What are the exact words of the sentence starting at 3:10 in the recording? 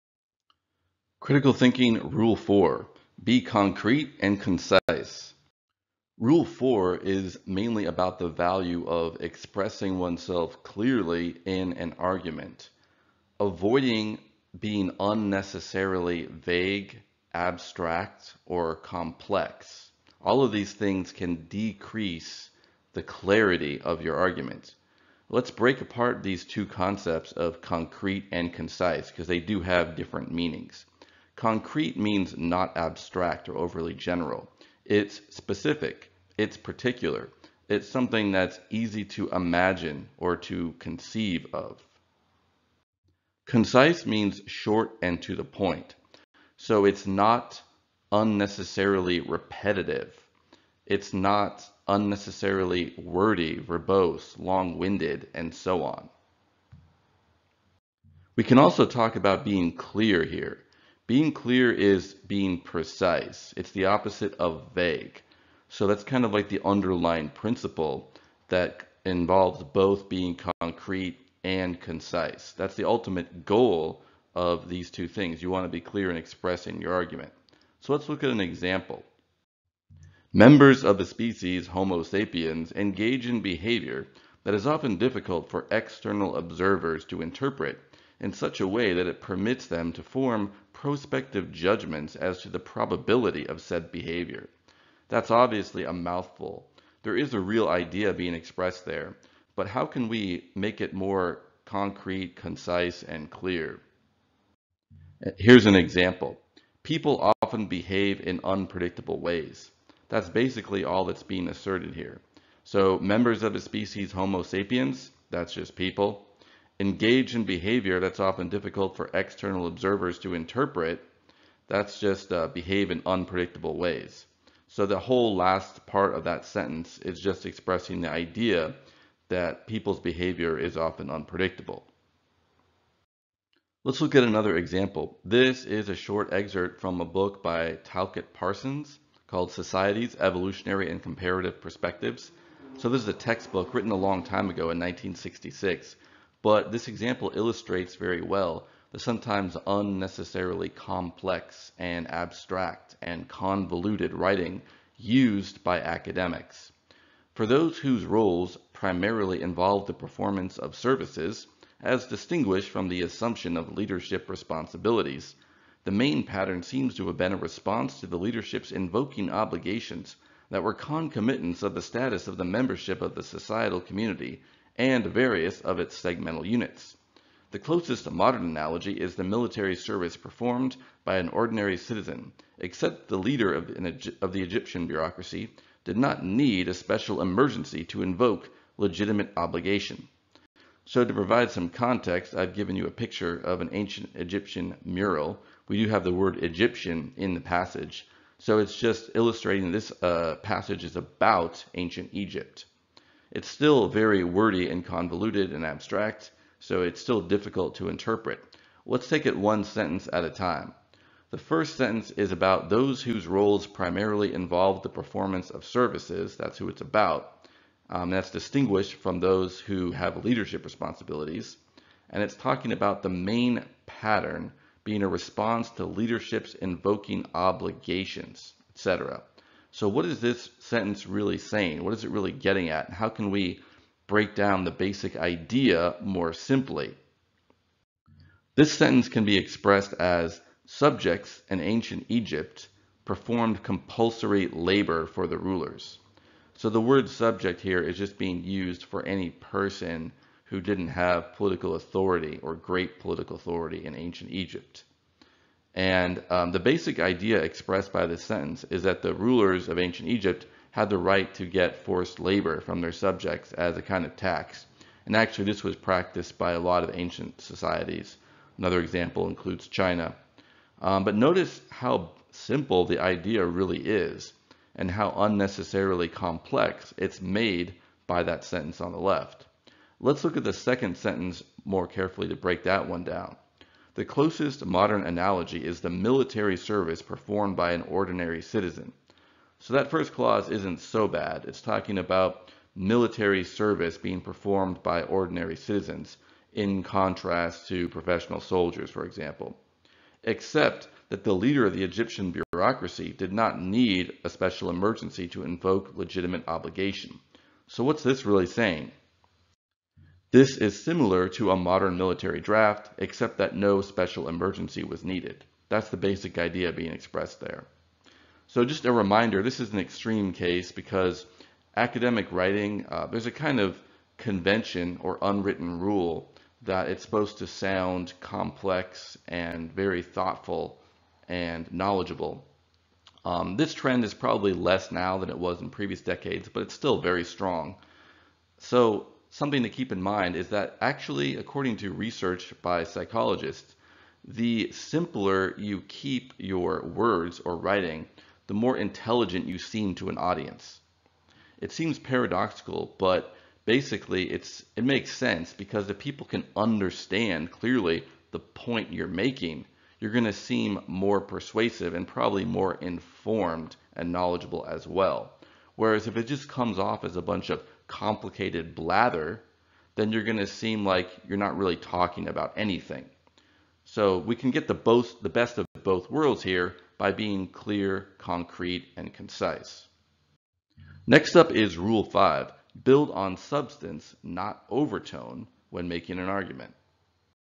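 So to provide some context, I've given you a picture of an ancient Egyptian mural.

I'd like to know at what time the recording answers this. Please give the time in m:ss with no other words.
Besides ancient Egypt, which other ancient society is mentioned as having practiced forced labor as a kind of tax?
4:29.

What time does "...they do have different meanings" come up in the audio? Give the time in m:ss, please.
0:29.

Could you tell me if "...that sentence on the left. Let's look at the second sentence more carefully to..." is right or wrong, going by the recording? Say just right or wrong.
right.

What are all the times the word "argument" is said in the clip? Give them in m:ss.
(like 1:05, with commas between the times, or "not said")
0:11, 0:24, 1:16, 6:26.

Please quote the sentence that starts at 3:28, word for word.
Let's take it one sentence at a time.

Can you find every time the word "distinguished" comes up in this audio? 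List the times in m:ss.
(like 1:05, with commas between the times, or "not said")
2:42, 3:38.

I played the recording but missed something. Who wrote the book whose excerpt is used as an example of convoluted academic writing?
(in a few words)
Talcott Parsons.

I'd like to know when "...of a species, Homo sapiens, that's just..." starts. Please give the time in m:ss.
1:53.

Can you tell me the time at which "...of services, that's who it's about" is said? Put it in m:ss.
3:35.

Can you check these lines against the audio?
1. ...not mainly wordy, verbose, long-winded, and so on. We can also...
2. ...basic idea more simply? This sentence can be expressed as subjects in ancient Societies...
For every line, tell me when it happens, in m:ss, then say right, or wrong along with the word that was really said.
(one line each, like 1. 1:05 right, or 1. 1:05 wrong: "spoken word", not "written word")
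1. 0:51 wrong: "unnecessarily", not "mainly"
2. 3:54 wrong: "Egypt", not "Societies".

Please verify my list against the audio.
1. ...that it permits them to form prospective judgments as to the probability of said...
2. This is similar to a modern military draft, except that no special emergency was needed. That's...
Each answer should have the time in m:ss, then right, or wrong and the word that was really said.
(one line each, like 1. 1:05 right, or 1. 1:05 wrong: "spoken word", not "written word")
1. 1:28 right
2. 5:10 right.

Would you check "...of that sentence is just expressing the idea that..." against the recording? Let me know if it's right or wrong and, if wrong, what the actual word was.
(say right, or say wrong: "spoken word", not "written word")
right.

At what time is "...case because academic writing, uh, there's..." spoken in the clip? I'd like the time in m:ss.
5:20.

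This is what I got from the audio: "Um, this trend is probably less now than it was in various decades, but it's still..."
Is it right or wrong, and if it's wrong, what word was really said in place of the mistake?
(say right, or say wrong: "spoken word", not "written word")
wrong: "previous", not "various".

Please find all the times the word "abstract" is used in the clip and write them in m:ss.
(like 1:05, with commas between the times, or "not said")
0:17, 0:32, 2:32, 3:25.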